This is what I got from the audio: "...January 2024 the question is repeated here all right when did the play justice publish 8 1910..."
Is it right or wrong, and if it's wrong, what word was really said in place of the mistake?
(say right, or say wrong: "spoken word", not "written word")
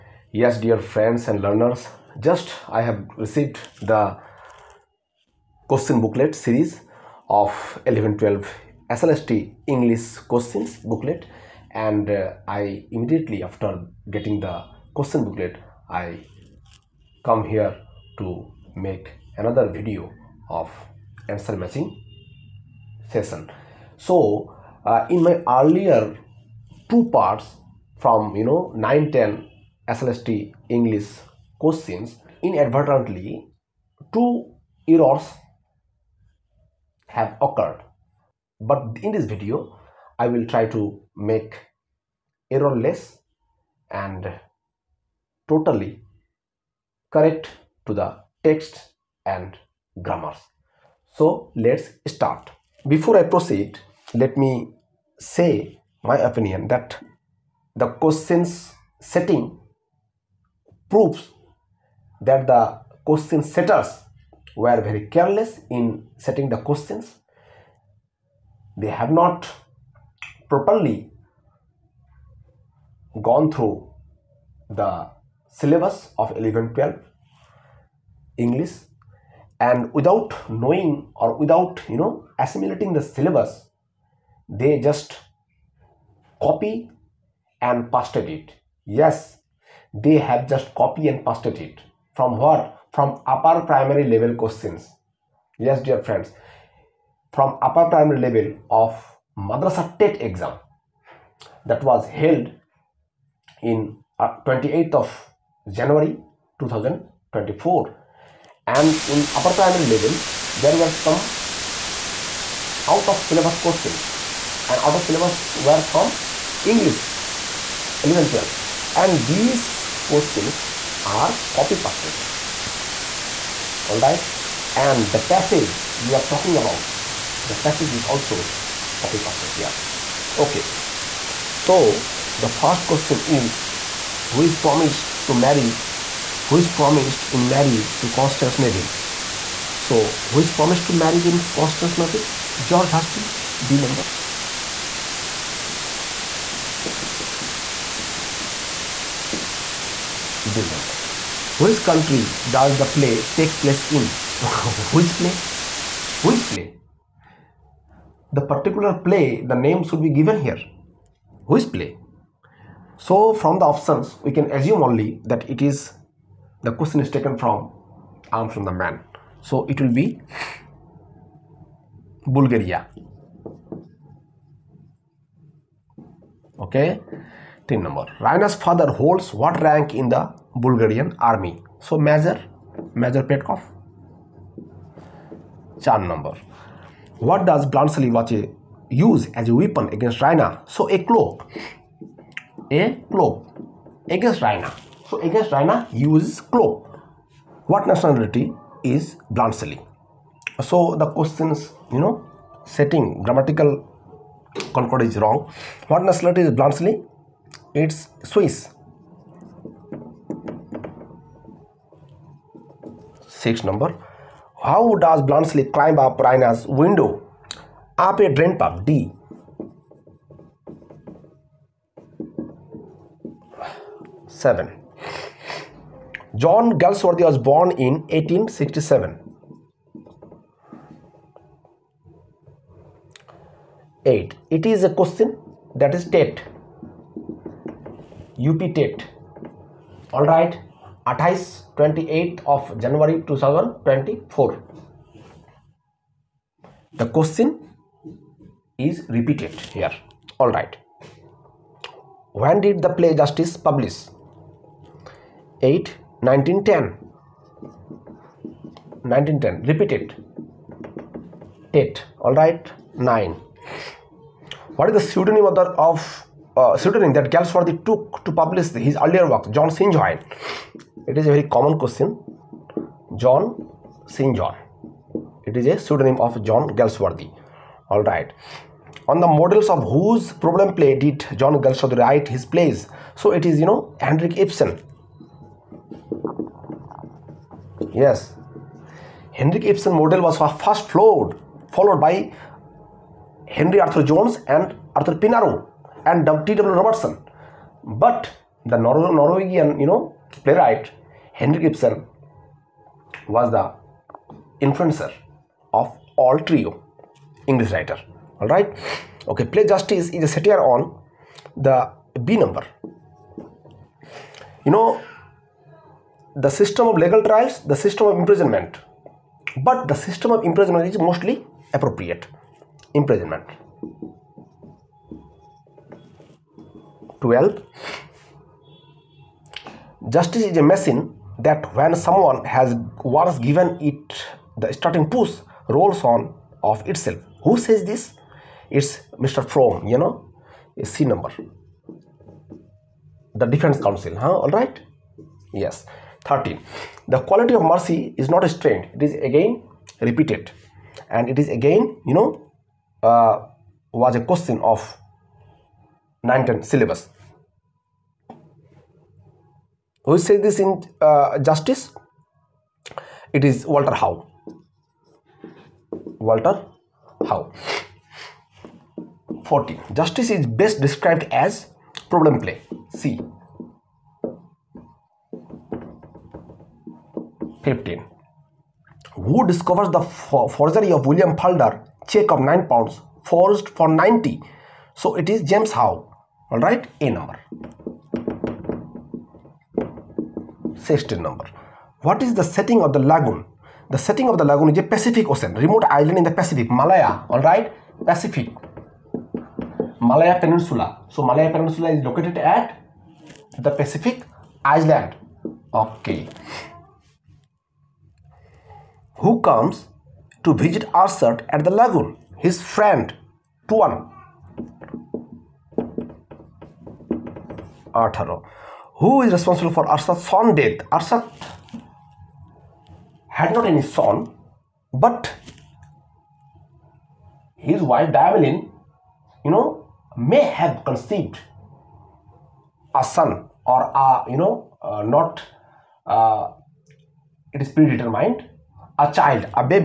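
right.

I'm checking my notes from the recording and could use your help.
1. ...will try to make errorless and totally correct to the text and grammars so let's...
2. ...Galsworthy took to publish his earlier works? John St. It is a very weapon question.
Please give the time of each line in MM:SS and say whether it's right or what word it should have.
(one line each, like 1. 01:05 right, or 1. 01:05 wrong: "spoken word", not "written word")
1. 00:40 right
2. 04:27 wrong: "common", not "weapon".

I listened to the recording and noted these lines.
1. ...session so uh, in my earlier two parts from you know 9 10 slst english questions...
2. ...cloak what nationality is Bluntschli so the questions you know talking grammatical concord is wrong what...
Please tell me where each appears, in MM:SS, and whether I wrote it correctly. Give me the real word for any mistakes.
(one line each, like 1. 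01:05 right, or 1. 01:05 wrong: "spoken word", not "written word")
1. 00:23 right
2. 03:16 wrong: "setting", not "talking".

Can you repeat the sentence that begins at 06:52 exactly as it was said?
His friend Tuan Arthur, who is responsible for Arsat's son death.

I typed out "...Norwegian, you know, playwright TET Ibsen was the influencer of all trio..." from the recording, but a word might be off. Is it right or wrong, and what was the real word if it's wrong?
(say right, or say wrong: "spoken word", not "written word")
wrong: "Henrik", not "TET".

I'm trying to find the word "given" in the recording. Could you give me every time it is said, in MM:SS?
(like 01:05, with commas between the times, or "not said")
02:40, 05:33.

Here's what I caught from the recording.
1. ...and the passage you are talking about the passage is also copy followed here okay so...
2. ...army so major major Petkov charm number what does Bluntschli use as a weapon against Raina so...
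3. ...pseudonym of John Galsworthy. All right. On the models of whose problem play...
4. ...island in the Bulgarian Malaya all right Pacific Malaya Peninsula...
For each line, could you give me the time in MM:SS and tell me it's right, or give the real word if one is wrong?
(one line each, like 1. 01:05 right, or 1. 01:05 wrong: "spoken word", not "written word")
1. 02:04 wrong: "pasted", not "followed"
2. 03:01 right
3. 04:35 right
4. 06:35 wrong: "Pacific", not "Bulgarian".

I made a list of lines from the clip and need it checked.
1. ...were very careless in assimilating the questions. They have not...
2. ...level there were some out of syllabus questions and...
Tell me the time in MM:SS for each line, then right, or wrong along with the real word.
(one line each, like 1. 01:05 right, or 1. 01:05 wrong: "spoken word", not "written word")
1. 01:04 wrong: "setting", not "assimilating"
2. 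01:49 right.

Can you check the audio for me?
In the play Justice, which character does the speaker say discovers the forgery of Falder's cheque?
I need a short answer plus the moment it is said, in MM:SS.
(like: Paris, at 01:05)
James Howe, at 06:25.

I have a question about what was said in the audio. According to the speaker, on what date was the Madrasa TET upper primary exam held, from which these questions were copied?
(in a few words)
28 January 2024.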